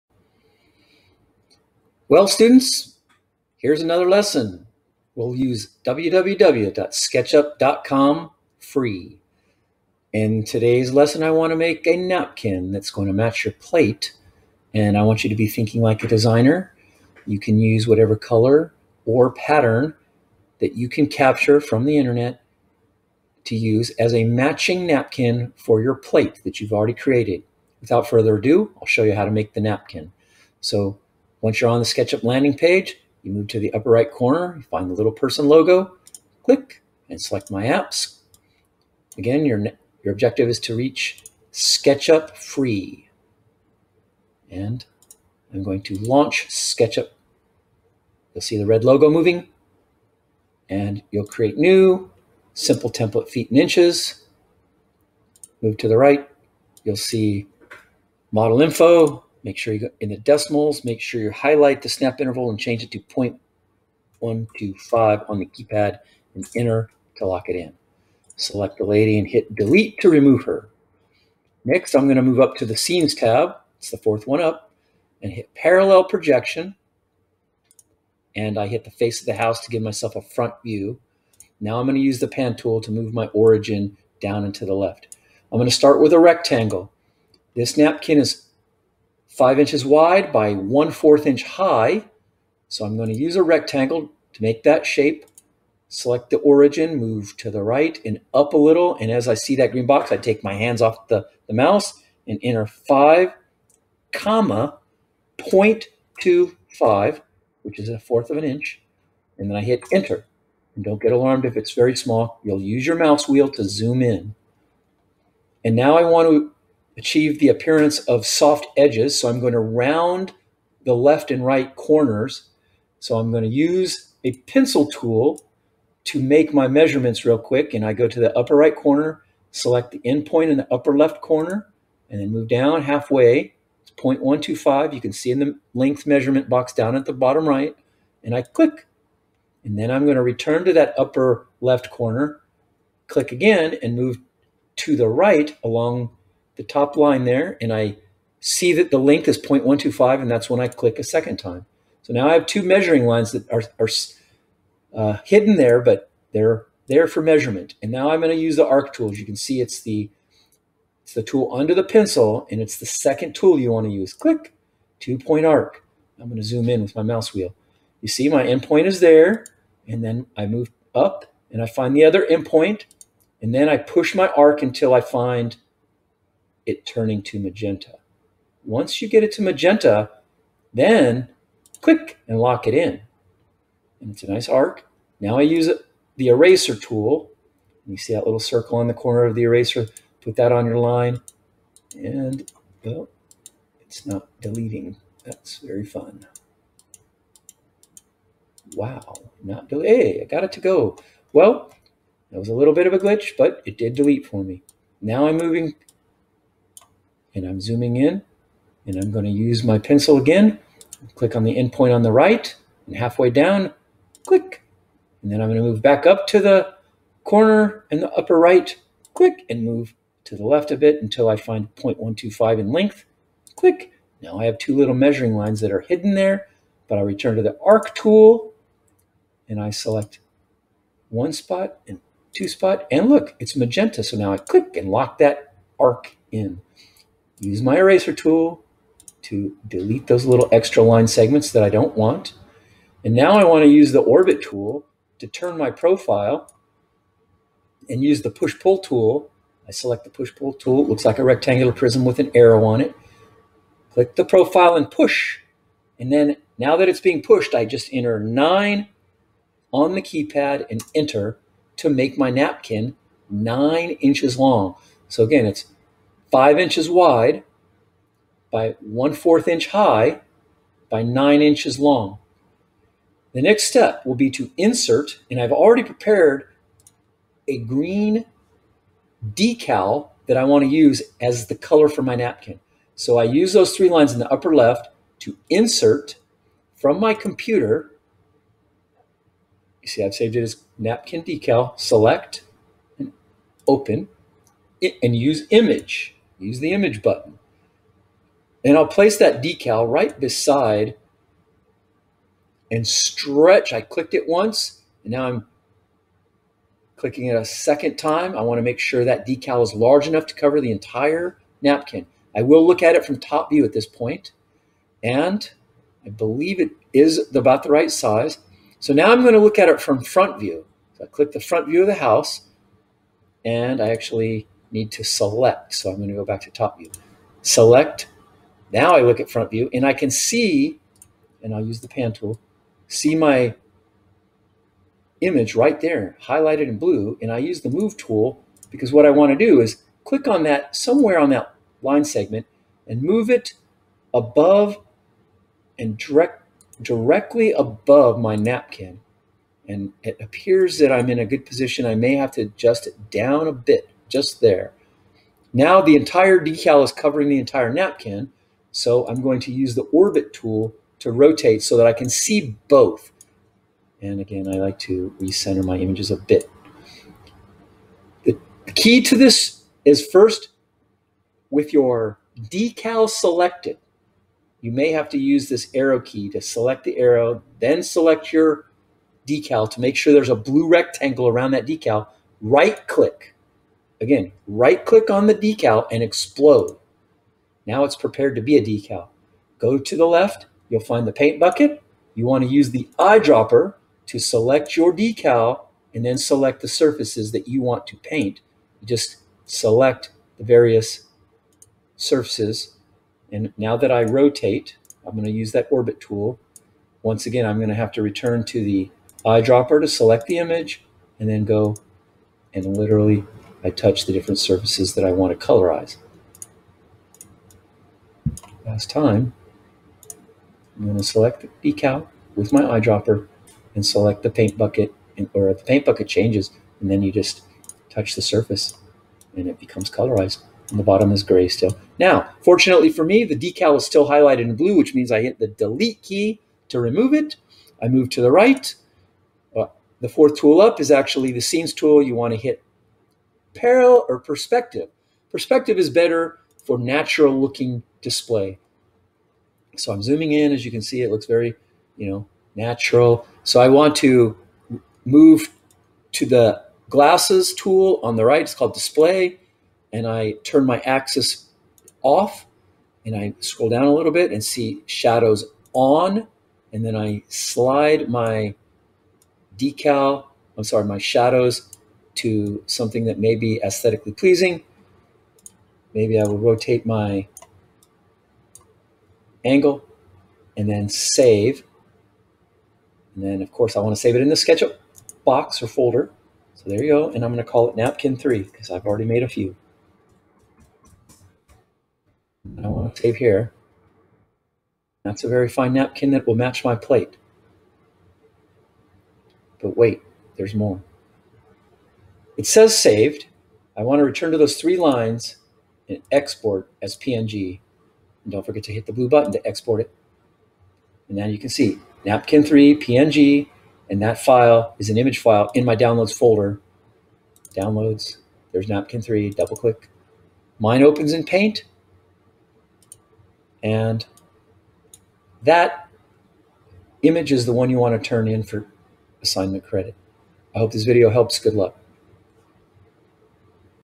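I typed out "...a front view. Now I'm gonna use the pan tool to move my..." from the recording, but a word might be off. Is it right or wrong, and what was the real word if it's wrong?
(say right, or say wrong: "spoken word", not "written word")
right.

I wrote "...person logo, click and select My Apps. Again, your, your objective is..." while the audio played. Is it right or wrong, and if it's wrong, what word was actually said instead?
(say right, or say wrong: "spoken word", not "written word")
right.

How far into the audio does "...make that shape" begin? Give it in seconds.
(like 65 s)
94 s.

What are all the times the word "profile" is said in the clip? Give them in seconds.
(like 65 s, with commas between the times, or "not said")
245 s, 254 s.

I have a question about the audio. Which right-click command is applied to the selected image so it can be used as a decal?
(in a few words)
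explode.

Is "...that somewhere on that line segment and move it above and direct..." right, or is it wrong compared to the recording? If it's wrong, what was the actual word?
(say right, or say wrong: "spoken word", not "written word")
right.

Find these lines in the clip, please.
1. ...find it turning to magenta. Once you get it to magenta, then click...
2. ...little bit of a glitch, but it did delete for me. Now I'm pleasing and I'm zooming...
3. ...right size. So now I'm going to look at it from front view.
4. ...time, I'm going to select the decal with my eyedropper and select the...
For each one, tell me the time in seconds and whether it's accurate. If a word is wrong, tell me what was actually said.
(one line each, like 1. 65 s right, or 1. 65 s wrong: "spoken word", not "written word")
1. 175 s right
2. 202 s wrong: "moving", not "pleasing"
3. 317 s right
4. 418 s right.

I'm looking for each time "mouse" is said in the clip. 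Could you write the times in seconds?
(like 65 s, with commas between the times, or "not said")
101 s, 112 s, 167 s.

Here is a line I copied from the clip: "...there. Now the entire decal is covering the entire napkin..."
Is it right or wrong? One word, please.
right.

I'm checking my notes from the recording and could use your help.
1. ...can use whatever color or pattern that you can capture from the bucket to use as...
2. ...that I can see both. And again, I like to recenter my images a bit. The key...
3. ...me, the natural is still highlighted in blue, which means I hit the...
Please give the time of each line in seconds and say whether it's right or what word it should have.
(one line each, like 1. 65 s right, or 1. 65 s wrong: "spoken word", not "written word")
1. 17 s wrong: "internet", not "bucket"
2. 361 s right
3. 433 s wrong: "decal", not "natural".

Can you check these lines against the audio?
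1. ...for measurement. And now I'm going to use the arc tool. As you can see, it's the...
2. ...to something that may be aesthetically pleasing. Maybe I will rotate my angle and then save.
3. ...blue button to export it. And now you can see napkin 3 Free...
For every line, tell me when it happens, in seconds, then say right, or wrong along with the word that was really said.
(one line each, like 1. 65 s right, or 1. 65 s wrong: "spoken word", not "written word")
1. 157 s right
2. 472 s right
3. 508 s wrong: "PNG", not "Free".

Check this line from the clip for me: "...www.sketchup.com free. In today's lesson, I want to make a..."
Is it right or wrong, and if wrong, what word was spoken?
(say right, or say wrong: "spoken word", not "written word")
right.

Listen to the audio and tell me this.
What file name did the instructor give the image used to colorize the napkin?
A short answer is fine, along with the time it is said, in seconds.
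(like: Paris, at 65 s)
napkin decal, at 290 s.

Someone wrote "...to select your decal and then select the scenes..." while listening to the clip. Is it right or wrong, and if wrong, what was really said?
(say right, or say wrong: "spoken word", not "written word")
wrong: "surfaces", not "scenes".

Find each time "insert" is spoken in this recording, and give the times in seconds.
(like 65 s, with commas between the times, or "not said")
274 s, 285 s.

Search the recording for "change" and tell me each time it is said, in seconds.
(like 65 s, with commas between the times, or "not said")
62 s, 426 s.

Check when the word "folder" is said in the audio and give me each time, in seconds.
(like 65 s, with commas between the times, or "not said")
485 s, 516 s.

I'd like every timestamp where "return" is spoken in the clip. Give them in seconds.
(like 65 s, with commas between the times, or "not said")
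140 s, 227 s, 408 s, 504 s.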